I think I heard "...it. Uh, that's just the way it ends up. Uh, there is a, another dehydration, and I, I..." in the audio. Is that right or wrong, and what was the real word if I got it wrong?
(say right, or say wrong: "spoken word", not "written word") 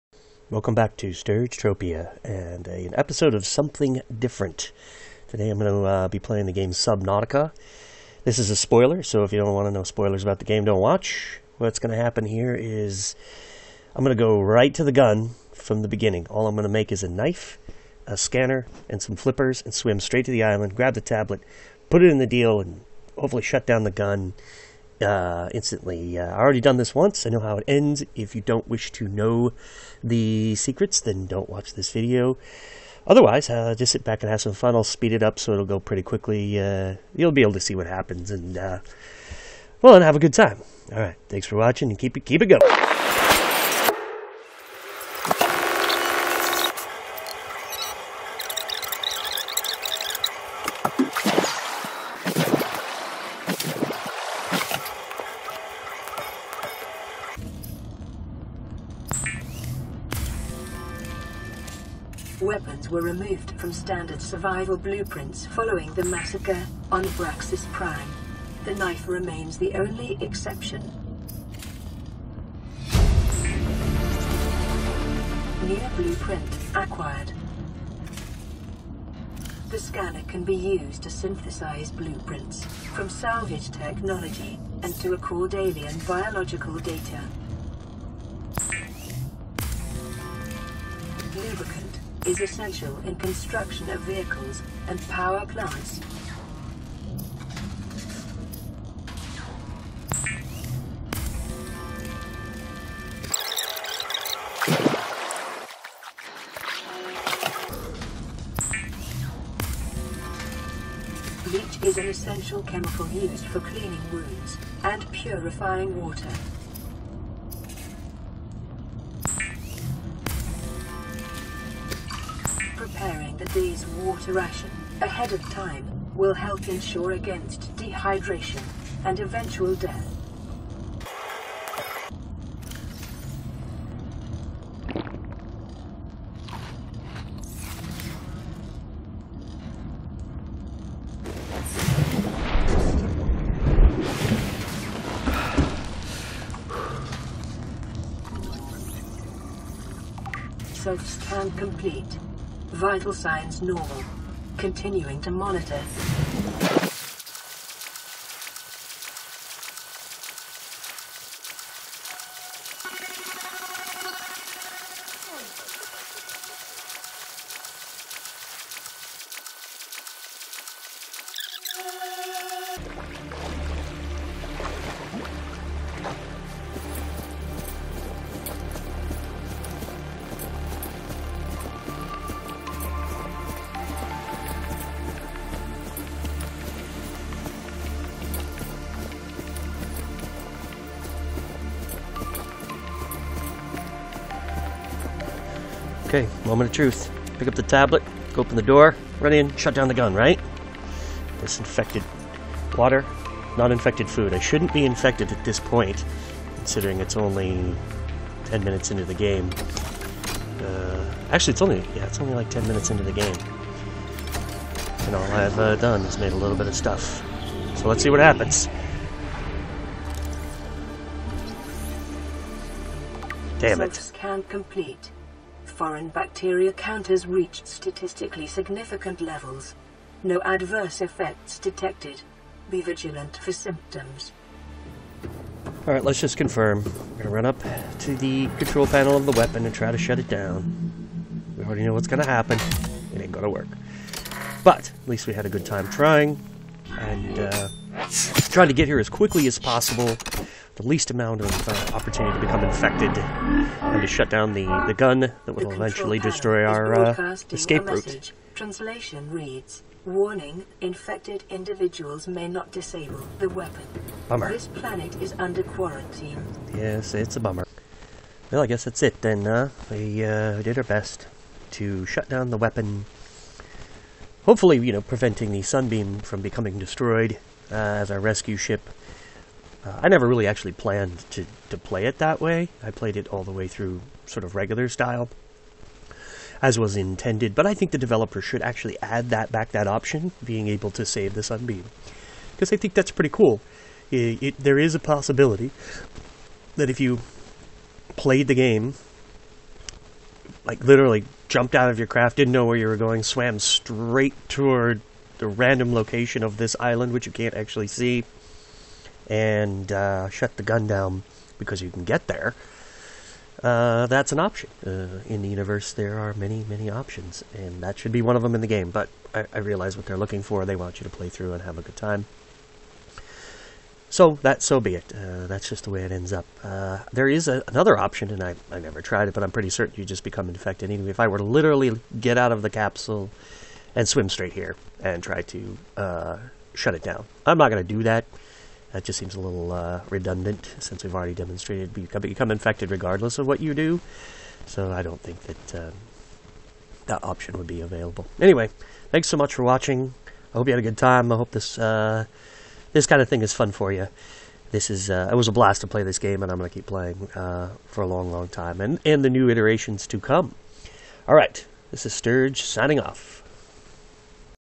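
wrong: "option", not "dehydration".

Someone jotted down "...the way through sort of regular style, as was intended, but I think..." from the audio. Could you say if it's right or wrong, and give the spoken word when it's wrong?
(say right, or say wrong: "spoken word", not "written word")
right.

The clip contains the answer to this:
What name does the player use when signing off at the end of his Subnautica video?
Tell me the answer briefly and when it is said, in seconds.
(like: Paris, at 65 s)
Stirge, at 362 s.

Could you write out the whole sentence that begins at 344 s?
So I don't think that uh, that option would be available.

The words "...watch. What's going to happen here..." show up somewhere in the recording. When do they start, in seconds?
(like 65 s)
10 s.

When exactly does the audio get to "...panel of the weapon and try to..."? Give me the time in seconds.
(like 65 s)
238 s.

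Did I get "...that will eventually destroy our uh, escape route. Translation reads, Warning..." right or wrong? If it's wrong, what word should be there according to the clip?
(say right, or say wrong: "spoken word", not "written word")
right.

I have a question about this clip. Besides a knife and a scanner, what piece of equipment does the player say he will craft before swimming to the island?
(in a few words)
Flippers.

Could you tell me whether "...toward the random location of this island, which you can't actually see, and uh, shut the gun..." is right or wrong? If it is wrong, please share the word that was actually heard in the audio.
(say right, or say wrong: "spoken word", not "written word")
right.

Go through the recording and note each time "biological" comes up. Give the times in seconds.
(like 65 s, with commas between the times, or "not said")
86 s.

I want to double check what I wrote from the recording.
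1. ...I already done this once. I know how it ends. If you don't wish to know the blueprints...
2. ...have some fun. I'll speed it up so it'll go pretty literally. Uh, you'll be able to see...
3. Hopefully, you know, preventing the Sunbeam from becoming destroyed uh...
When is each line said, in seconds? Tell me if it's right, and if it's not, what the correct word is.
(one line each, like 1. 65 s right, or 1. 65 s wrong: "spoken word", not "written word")
1. 26 s wrong: "secrets", not "blueprints"
2. 34 s wrong: "quickly", not "literally"
3. 274 s right.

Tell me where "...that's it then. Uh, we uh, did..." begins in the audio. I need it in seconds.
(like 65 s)
268 s.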